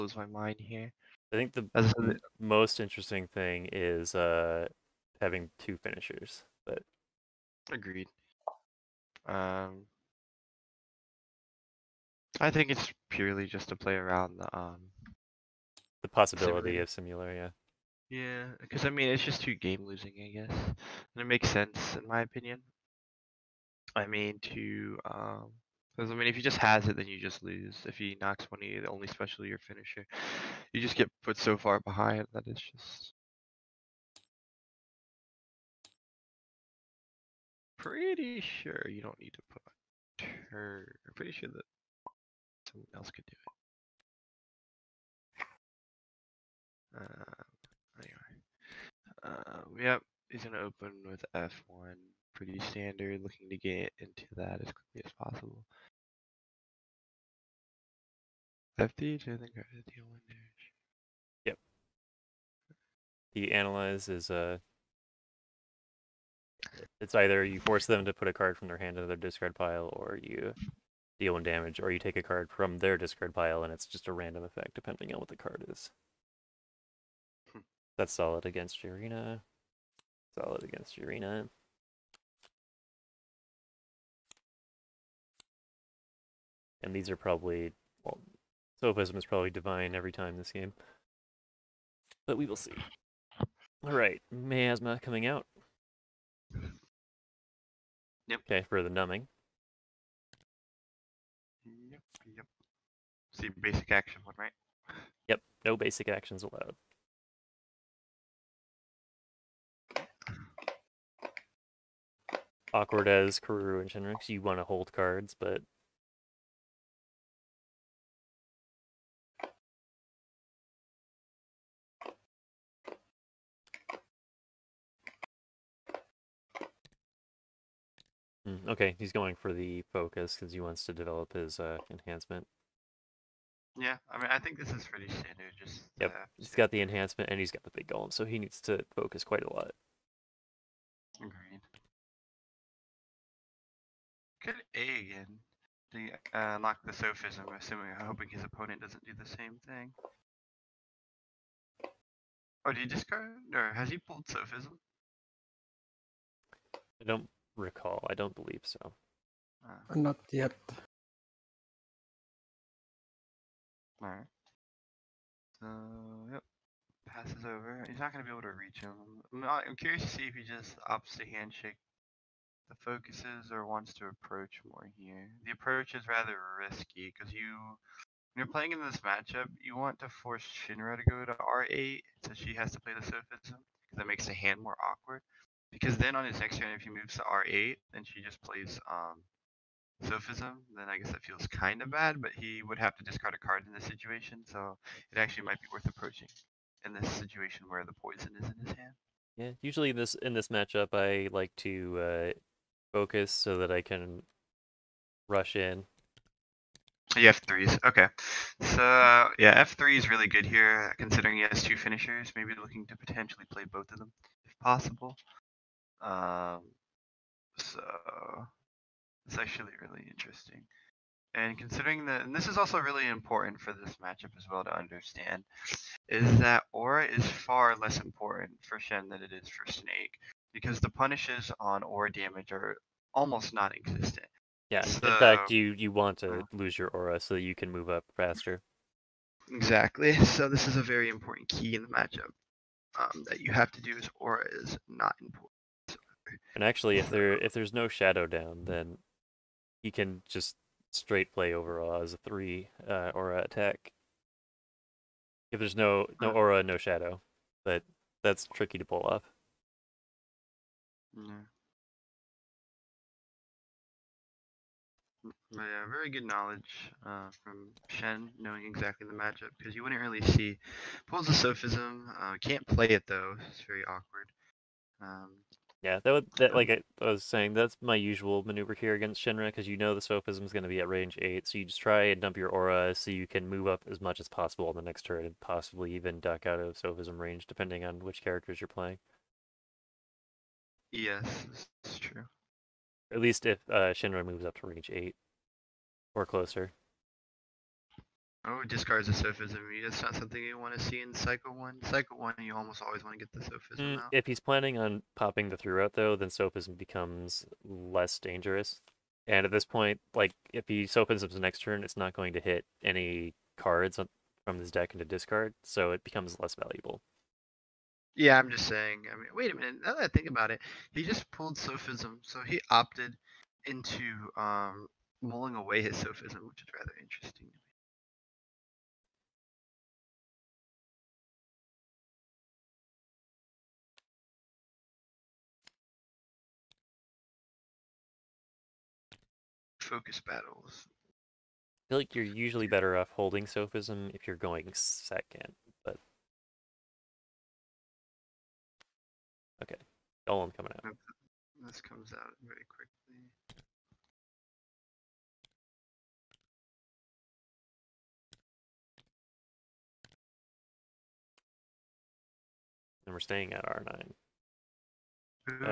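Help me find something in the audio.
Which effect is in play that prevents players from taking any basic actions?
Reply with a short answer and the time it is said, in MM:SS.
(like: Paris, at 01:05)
Miasma, at 01:34.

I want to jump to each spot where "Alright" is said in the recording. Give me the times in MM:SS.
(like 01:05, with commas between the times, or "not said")
01:33, 02:44.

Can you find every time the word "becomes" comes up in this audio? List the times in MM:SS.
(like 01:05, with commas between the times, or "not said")
05:06, 05:16.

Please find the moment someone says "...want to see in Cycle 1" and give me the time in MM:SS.
05:00.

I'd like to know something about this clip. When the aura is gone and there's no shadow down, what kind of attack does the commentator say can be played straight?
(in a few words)
3 aura attack.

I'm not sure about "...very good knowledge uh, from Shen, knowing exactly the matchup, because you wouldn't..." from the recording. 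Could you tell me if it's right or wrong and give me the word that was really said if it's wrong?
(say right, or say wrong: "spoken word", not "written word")
right.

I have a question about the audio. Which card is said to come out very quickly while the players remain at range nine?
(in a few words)
Dolan.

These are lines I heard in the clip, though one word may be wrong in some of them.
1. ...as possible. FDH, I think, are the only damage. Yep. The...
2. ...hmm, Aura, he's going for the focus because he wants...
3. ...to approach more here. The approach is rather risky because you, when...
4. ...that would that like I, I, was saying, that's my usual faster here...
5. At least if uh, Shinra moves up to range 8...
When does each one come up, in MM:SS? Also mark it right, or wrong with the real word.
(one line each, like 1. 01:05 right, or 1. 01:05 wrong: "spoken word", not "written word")
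1. 00:55 right
2. 02:08 wrong: "Okay", not "Aura"
3. 02:53 right
4. 04:36 wrong: "maneuver", not "faster"
5. 04:53 right.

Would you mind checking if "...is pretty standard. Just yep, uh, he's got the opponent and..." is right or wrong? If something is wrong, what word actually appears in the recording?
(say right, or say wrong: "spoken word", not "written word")
wrong: "enhancement", not "opponent".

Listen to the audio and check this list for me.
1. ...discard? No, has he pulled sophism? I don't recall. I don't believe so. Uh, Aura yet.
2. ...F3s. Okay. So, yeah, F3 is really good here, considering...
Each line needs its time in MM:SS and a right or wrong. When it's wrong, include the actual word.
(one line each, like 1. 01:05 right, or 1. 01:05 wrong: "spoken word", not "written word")
1. 02:32 wrong: "Not", not "Aura"
2. 03:27 right.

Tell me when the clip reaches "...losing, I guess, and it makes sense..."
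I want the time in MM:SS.
00:19.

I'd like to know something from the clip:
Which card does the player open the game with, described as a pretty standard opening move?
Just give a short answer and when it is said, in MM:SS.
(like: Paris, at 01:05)
F1, at 00:51.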